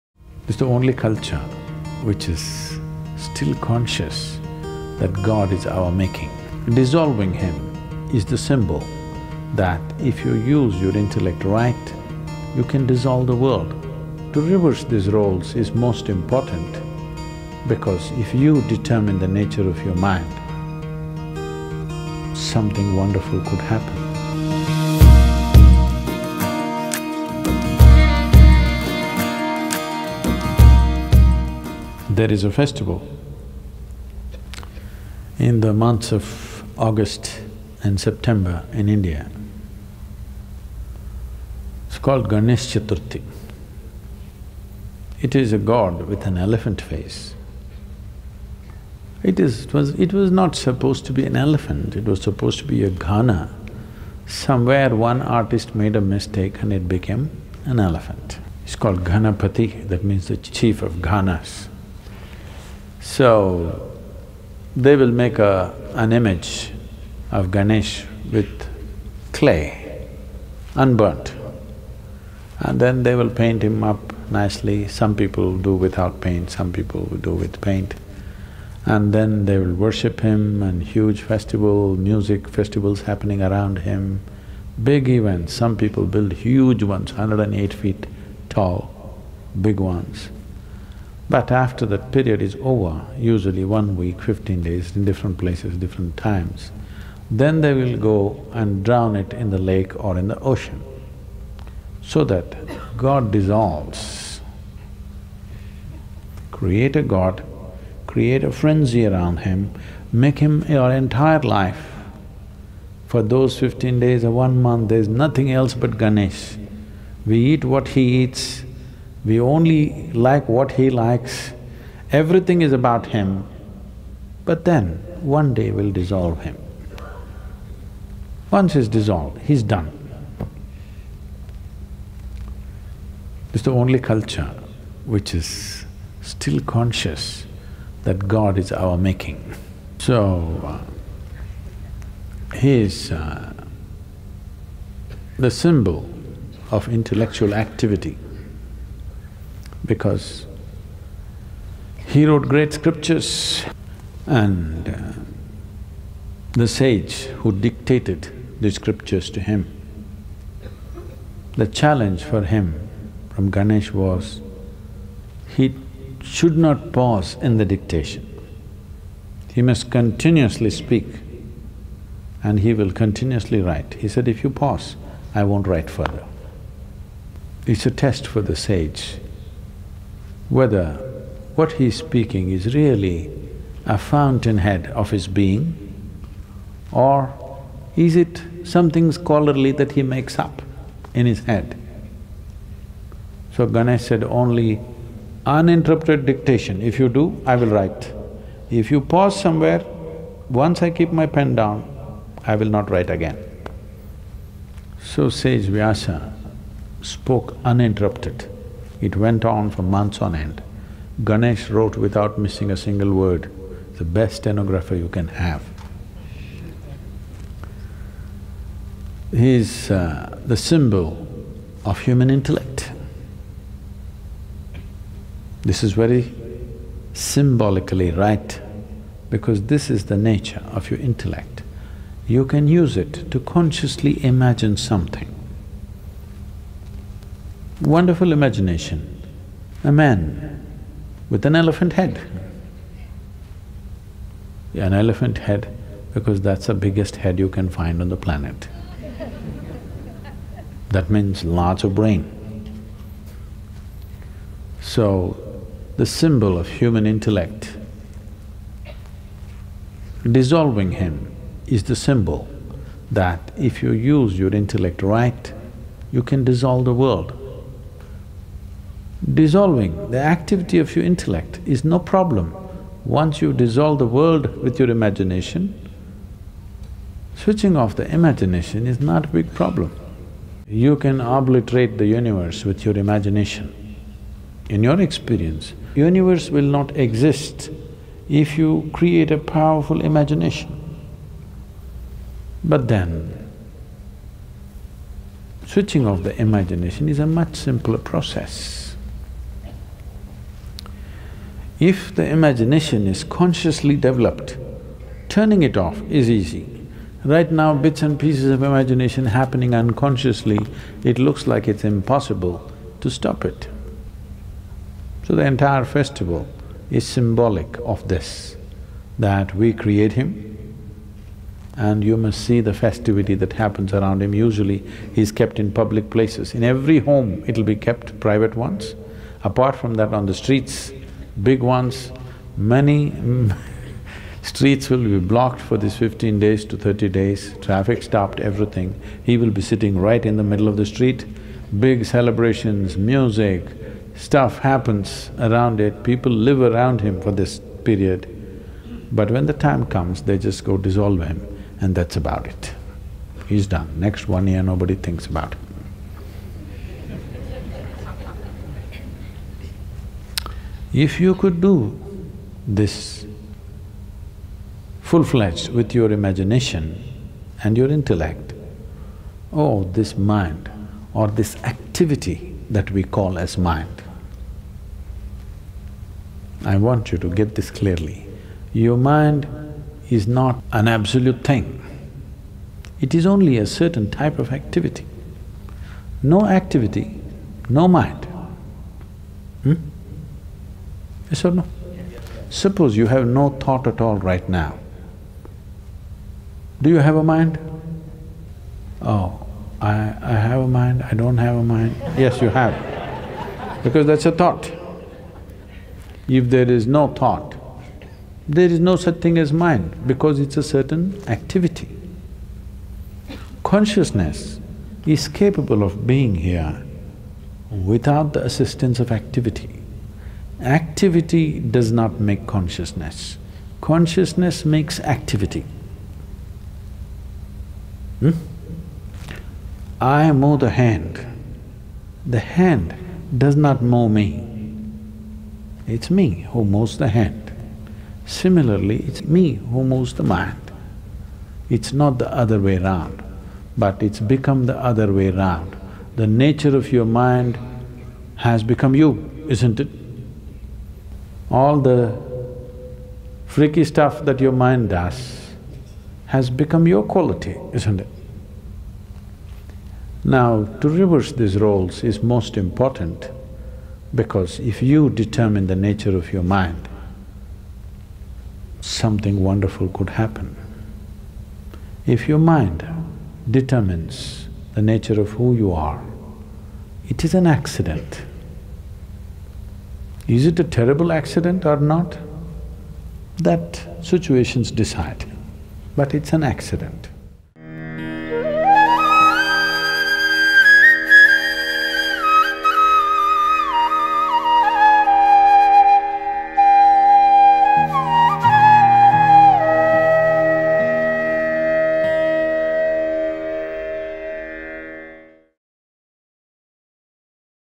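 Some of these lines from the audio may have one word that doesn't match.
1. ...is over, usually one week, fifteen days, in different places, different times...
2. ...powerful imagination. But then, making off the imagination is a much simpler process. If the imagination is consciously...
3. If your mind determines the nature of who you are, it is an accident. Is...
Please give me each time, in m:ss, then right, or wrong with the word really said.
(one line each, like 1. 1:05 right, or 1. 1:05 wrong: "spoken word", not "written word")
1. 1:32 right
2. 4:49 wrong: "switching", not "making"
3. 7:52 right.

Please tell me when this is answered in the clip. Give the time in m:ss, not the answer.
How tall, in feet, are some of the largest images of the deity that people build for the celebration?
1:27.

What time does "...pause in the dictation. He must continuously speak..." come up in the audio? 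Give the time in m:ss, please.
2:46.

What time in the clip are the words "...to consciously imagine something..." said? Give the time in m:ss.
3:53.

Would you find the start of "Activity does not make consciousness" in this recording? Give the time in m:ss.
7:00.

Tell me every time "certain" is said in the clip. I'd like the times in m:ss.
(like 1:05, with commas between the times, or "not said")
6:23, 6:50.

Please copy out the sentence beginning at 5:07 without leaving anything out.
Right now, bits and pieces of imagination happening unconsciously, it looks like it's impossible to stop it.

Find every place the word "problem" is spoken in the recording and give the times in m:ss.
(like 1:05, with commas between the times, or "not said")
4:31, 4:39.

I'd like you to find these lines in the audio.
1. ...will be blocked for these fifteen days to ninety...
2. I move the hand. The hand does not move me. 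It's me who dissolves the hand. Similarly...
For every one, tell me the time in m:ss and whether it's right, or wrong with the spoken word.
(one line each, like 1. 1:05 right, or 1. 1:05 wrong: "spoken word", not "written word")
1. 5:34 wrong: "thirty", not "ninety"
2. 7:09 wrong: "moves", not "dissolves".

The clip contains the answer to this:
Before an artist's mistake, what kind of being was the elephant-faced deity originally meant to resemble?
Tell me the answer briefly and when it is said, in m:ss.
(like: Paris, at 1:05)
gana, at 0:52.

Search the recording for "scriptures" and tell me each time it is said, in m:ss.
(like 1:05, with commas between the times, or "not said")
2:32, 2:38.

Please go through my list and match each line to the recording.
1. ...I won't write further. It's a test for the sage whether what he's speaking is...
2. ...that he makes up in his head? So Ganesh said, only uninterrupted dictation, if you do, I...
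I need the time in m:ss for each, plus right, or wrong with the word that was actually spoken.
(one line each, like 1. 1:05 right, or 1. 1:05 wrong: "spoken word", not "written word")
1. 2:55 right
2. 3:09 right.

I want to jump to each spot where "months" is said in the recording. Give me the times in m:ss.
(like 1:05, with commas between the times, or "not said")
0:35, 1:54, 3:29.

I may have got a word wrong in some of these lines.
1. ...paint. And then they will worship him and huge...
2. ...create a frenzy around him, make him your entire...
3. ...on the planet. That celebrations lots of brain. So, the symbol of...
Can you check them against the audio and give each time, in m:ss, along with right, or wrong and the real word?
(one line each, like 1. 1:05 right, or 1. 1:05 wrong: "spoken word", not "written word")
1. 1:17 right
2. 1:48 right
3. 4:08 wrong: "means", not "celebrations".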